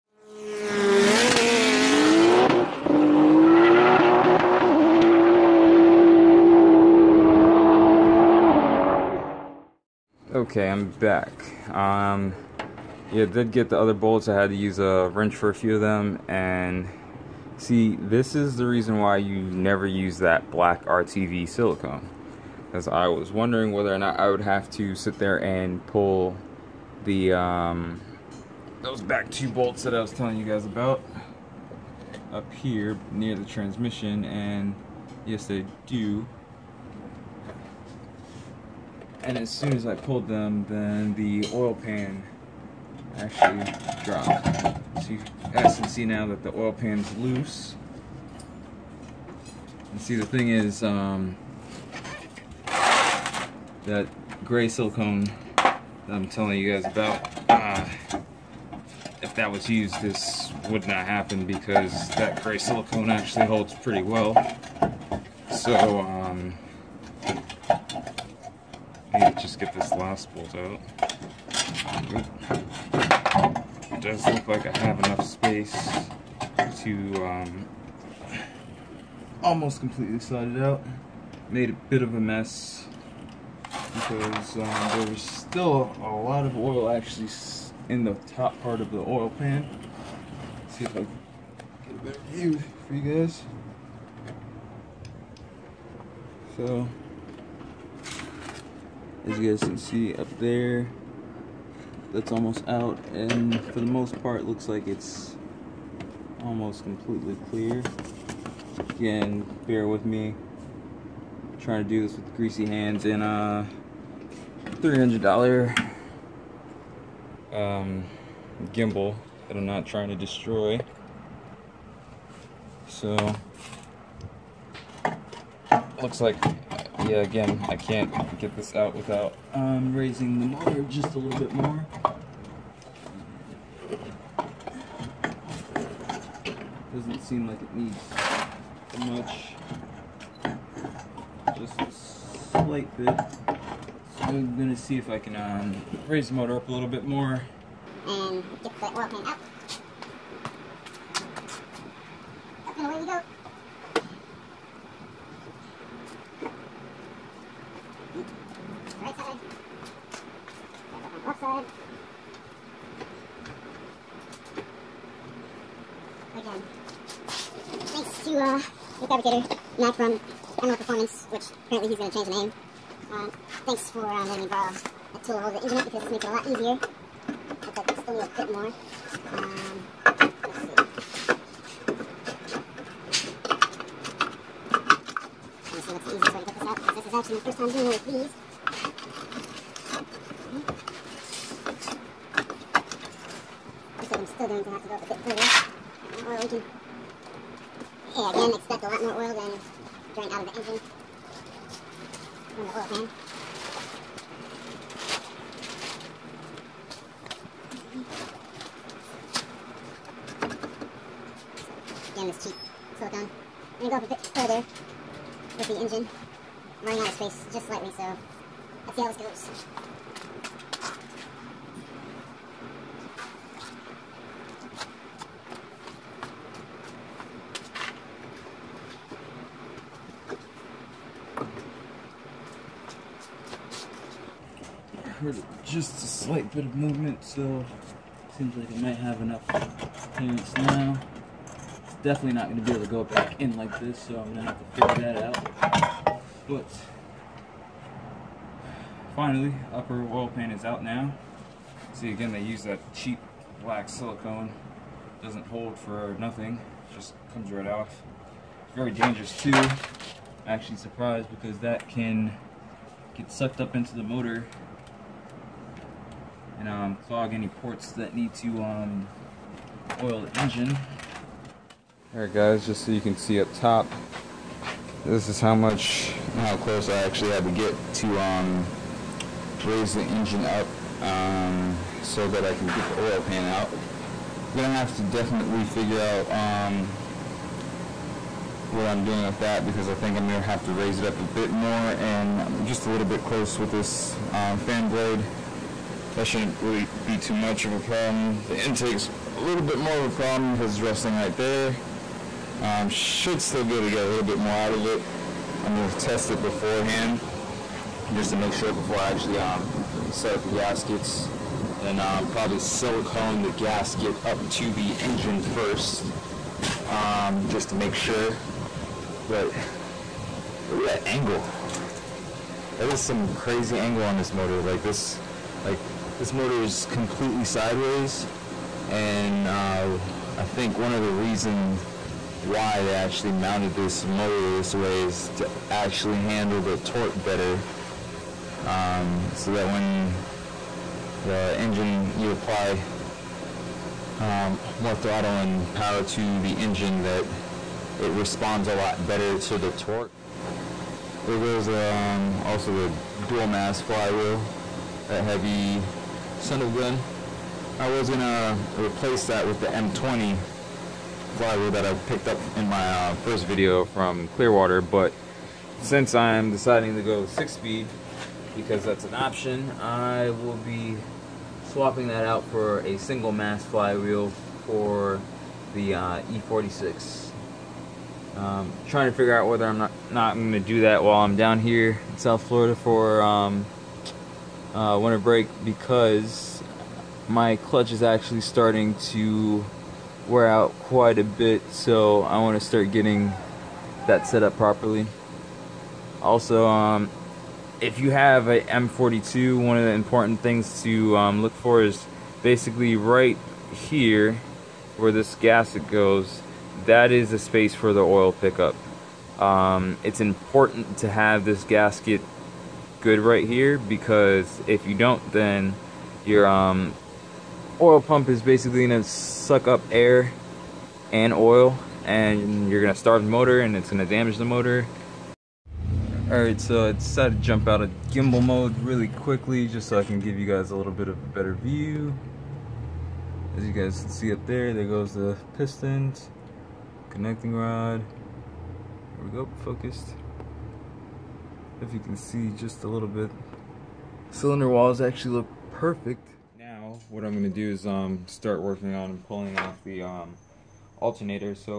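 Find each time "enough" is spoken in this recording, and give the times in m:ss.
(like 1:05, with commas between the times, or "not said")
1:14, 3:59.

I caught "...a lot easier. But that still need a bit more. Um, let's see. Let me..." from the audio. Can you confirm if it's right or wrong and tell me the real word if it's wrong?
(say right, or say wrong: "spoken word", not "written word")
right.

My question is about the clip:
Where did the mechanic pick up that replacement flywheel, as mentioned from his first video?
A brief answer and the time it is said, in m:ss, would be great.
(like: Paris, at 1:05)
Clearwater, at 6:04.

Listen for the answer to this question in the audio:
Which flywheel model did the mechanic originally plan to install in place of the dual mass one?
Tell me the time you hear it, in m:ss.
5:59.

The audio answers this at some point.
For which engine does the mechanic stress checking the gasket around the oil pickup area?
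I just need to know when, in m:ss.
6:38.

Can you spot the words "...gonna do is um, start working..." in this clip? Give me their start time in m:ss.
7:27.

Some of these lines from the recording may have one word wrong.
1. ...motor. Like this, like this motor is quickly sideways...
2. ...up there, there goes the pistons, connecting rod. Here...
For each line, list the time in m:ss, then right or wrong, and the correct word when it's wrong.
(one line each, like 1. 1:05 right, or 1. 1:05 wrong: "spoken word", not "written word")
1. 5:24 wrong: "completely", not "quickly"
2. 7:14 right.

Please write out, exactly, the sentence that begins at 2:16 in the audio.
Doesn't seem like it needs much.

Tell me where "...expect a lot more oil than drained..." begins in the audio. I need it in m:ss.
3:18.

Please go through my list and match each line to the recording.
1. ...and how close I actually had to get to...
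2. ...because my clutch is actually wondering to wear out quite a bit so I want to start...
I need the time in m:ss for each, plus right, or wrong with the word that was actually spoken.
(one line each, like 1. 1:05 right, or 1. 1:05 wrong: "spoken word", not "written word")
1. 4:36 right
2. 6:25 wrong: "starting", not "wondering".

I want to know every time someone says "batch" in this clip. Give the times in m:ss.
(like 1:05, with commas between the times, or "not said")
not said.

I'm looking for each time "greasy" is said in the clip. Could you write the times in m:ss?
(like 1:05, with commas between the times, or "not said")
1:52.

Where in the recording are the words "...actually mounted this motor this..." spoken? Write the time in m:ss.
5:32.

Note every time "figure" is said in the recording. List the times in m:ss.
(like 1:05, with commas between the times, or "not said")
4:04, 4:45, 6:19.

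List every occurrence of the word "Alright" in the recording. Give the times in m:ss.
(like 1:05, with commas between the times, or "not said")
4:32, 7:06.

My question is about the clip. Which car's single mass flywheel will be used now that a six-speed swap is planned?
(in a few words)
E46.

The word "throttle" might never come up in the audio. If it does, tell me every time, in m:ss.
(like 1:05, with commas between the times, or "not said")
5:44.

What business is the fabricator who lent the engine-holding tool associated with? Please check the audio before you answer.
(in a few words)
Emerald Performance.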